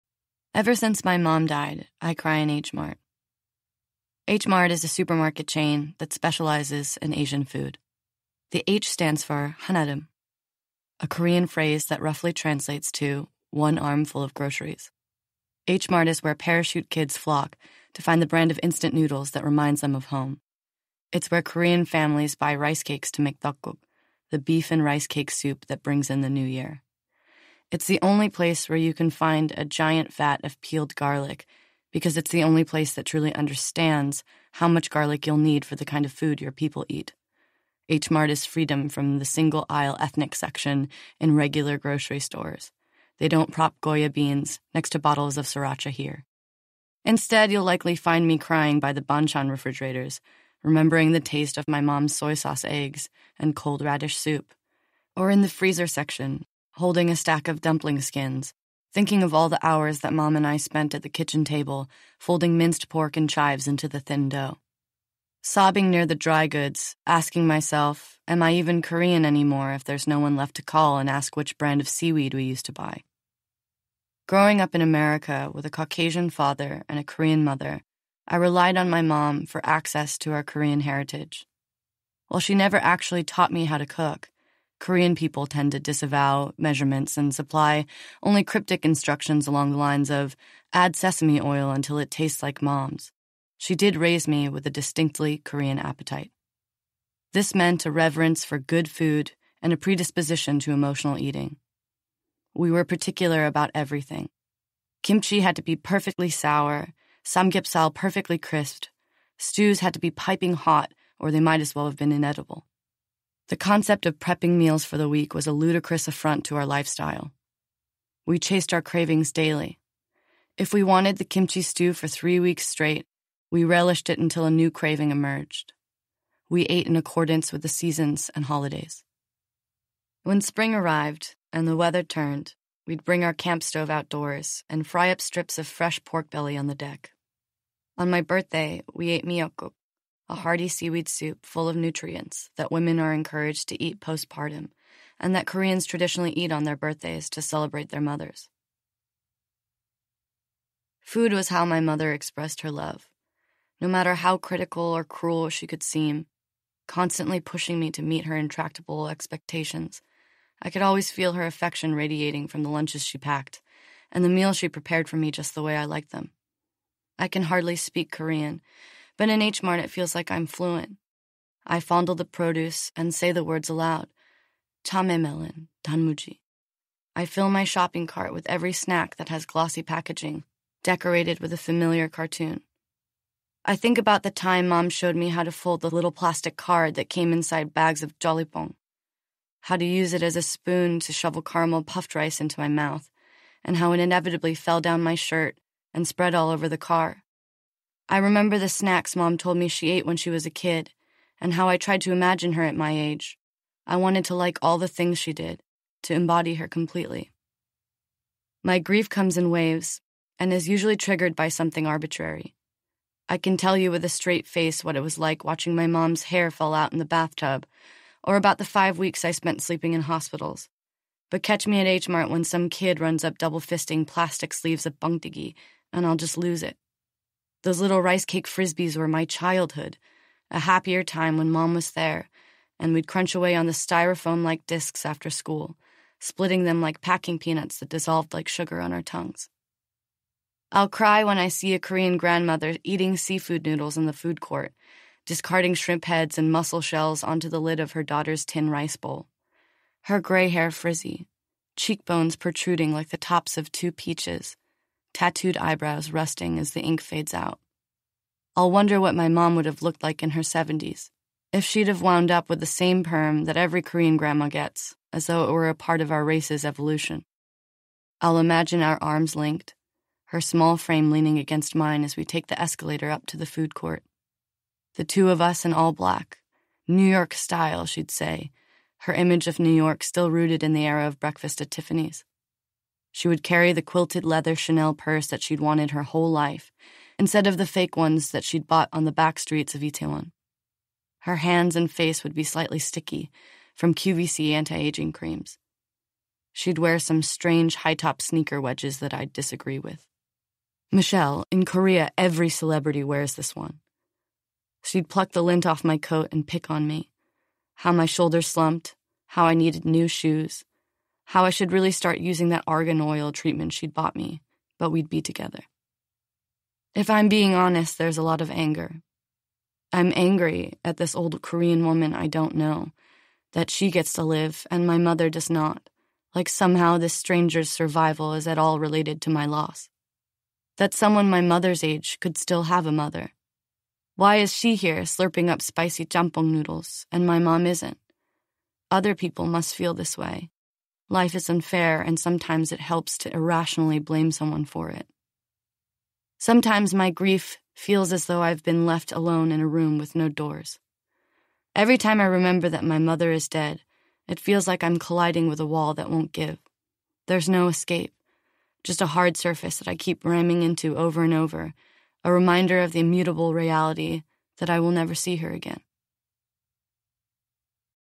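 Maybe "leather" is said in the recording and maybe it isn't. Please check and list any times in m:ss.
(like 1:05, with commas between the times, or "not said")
4:44.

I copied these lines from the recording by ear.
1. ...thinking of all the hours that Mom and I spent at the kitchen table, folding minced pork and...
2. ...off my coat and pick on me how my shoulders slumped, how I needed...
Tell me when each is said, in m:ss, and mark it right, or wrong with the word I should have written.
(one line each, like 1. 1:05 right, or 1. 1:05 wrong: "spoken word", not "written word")
1. 0:58 right
2. 5:05 right.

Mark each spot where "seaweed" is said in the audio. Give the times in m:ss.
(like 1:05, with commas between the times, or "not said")
1:11, 2:20.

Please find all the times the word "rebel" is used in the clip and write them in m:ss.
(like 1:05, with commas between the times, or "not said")
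not said.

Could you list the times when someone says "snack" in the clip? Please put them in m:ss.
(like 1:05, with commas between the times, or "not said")
2:58, 3:18.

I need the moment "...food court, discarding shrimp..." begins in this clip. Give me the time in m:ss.
4:04.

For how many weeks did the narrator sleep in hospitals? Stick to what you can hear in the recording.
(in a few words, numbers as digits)
5.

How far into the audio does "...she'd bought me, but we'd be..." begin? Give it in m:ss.
5:13.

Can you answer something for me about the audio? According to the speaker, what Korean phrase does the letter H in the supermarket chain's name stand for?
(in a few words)
Hanadim.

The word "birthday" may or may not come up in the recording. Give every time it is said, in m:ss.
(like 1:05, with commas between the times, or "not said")
2:18, 2:26.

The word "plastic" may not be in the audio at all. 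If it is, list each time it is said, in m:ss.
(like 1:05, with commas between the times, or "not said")
3:06, 3:44.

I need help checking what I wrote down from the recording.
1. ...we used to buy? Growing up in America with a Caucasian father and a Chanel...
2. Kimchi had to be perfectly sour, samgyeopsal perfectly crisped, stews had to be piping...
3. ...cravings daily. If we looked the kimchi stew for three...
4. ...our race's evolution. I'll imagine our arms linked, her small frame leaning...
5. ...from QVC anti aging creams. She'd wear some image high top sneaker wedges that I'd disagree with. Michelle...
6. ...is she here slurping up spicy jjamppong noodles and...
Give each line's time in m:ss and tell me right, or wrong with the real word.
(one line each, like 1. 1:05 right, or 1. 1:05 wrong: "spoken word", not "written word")
1. 1:12 wrong: "Korean", not "Chanel"
2. 1:45 right
3. 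1:58 wrong: "wanted", not "looked"
4. 4:26 right
5. 4:53 wrong: "strange", not "image"
6. 5:34 right.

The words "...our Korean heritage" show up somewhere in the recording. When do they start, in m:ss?
1:20.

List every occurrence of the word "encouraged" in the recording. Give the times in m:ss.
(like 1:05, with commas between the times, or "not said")
2:23.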